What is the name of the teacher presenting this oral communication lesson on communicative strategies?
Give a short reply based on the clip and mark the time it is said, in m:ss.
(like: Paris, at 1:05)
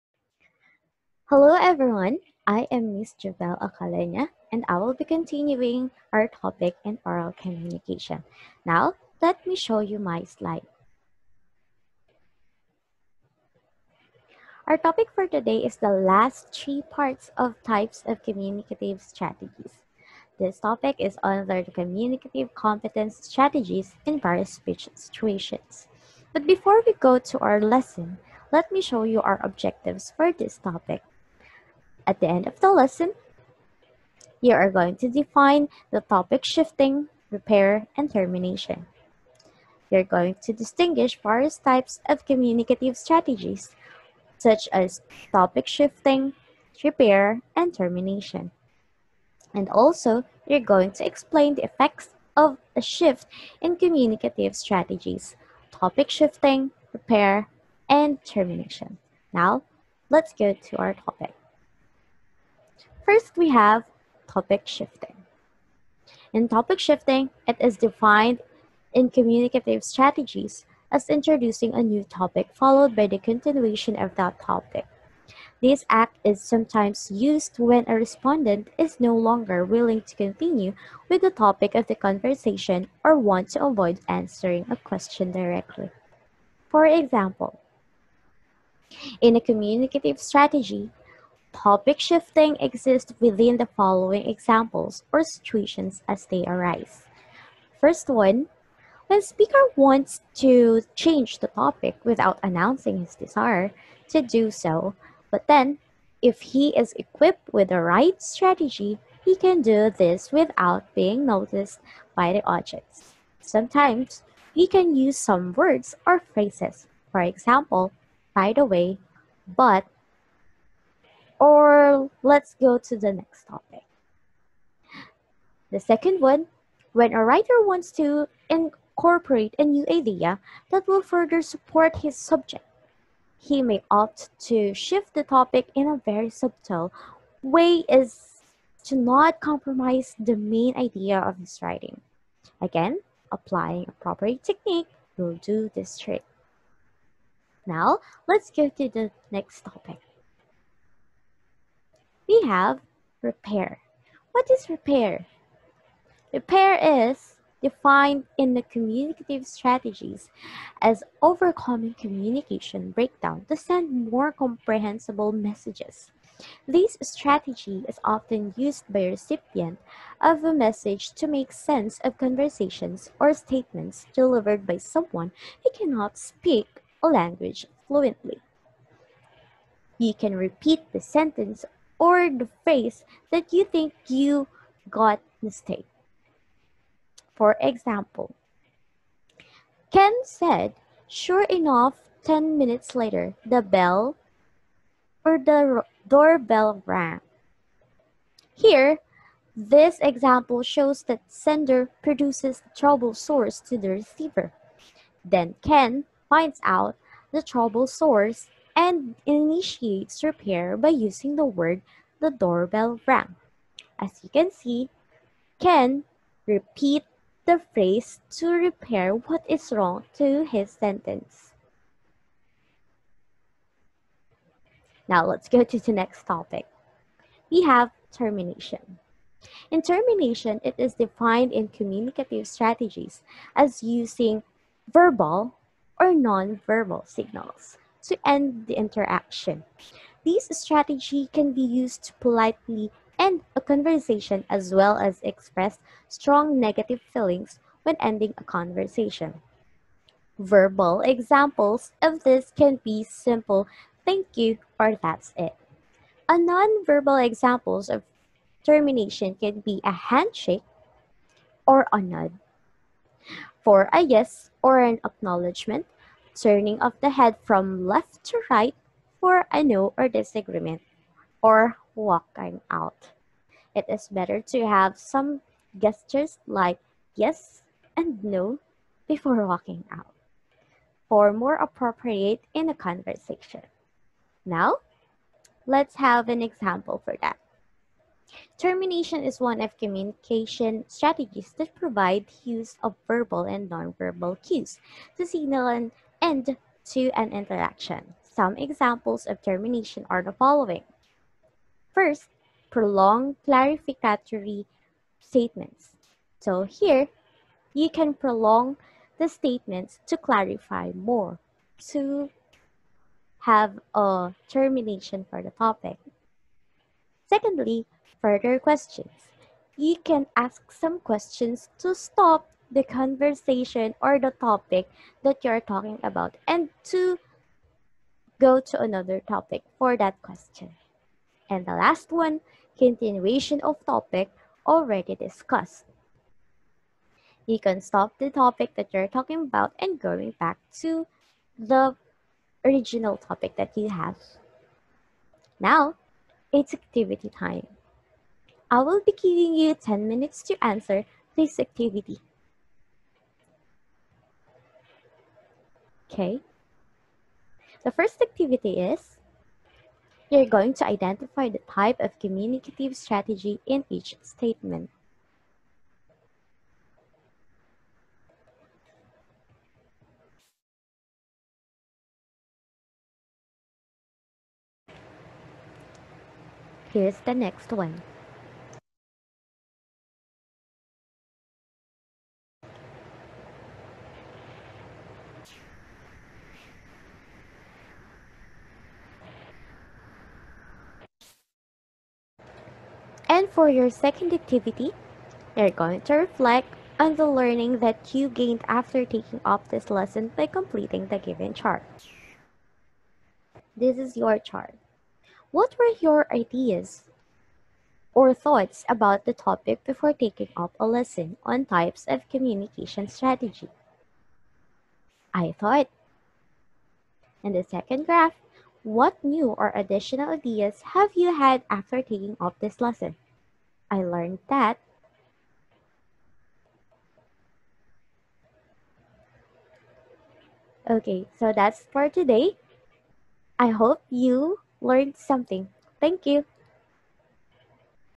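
Jovel Ocaleña, at 0:03.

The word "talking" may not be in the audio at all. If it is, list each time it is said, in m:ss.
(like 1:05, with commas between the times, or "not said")
5:25, 5:39.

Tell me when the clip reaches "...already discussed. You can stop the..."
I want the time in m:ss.
5:34.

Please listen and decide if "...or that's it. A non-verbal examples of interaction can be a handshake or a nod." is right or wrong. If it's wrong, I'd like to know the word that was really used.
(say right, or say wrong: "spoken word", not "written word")
wrong: "termination", not "interaction".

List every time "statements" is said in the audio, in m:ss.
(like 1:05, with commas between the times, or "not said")
2:53, 5:05, 5:09, 6:04.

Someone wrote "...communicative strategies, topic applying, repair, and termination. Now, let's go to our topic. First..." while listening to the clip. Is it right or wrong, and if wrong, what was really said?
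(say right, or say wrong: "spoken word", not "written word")
wrong: "shifting", not "applying".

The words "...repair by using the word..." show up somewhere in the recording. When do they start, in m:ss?
3:30.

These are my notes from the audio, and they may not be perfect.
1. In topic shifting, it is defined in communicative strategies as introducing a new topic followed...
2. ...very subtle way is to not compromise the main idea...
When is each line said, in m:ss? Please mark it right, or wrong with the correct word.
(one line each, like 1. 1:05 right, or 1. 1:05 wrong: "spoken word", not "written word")
1. 1:06 right
2. 2:16 right.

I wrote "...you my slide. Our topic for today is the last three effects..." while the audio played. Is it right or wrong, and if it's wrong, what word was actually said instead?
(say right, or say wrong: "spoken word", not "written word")
wrong: "parts", not "effects".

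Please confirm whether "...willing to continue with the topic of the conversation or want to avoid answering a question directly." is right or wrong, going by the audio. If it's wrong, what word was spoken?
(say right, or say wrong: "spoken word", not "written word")
right.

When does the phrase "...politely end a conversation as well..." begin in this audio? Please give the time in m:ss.
4:02.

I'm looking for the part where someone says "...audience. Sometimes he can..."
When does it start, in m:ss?
1:52.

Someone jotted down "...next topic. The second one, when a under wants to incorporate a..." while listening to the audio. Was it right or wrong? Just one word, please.
wrong.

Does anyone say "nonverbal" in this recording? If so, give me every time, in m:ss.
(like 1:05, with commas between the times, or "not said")
3:56, 4:53.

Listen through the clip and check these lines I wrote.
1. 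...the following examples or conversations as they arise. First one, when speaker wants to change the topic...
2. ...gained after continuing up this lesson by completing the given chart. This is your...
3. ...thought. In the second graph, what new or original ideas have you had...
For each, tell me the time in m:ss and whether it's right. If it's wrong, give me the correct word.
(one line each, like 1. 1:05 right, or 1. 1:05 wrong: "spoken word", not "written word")
1. 1:33 wrong: "situations", not "conversations"
2. 6:38 wrong: "taking", not "continuing"
3. 6:55 wrong: "additional", not "original".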